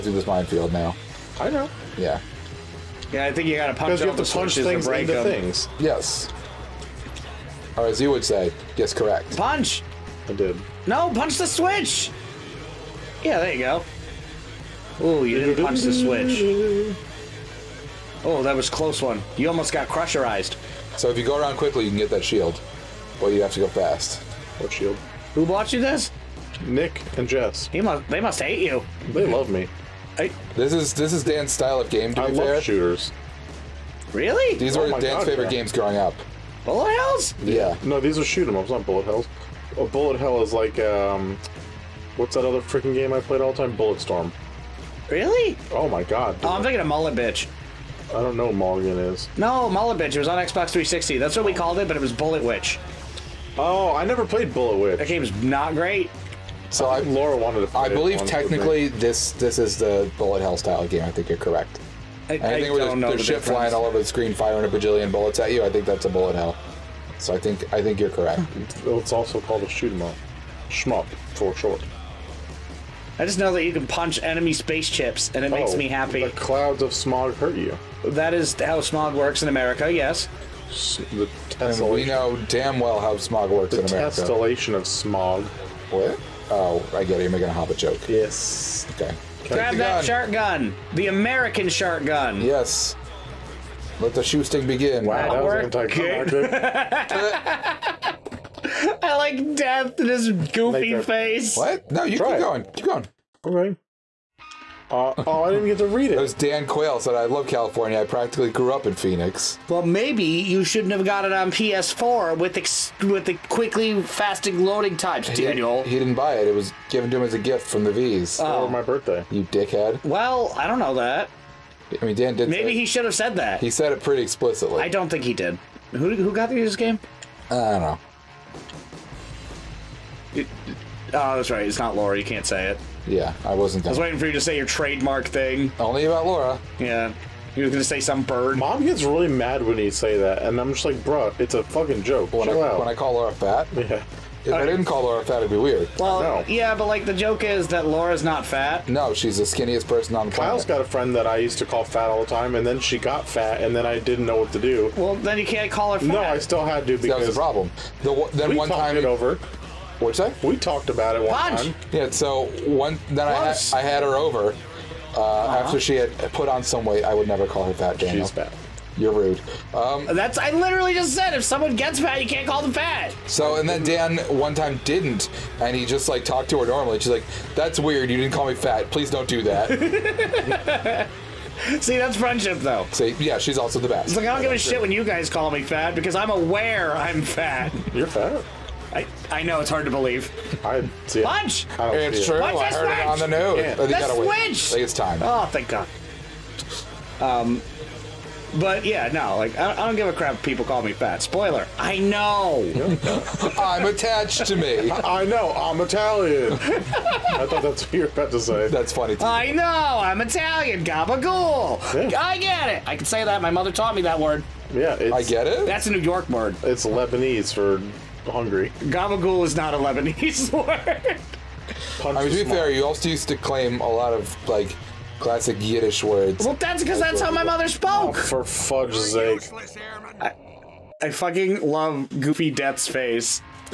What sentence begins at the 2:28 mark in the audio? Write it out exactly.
No, she's the skinniest person on the Kyle's planet.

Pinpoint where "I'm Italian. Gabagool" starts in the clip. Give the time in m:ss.
3:30.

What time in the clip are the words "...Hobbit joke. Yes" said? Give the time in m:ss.
1:27.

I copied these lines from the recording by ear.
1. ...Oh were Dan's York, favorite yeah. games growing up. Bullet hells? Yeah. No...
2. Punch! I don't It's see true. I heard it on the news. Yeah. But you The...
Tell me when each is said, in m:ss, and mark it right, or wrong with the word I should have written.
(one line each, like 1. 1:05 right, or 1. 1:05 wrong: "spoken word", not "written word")
1. 0:34 wrong: "God", not "York"
2. 3:11 right.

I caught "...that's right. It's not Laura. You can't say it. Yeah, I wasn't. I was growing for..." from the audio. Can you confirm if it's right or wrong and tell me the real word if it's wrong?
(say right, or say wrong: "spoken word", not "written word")
wrong: "waiting", not "growing".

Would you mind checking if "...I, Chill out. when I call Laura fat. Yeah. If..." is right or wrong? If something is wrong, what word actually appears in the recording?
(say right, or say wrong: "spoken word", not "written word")
right.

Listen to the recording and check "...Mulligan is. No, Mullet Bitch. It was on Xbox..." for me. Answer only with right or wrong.
right.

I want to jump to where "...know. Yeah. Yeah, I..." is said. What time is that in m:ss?
0:01.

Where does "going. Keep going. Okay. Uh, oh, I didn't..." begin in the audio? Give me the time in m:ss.
1:42.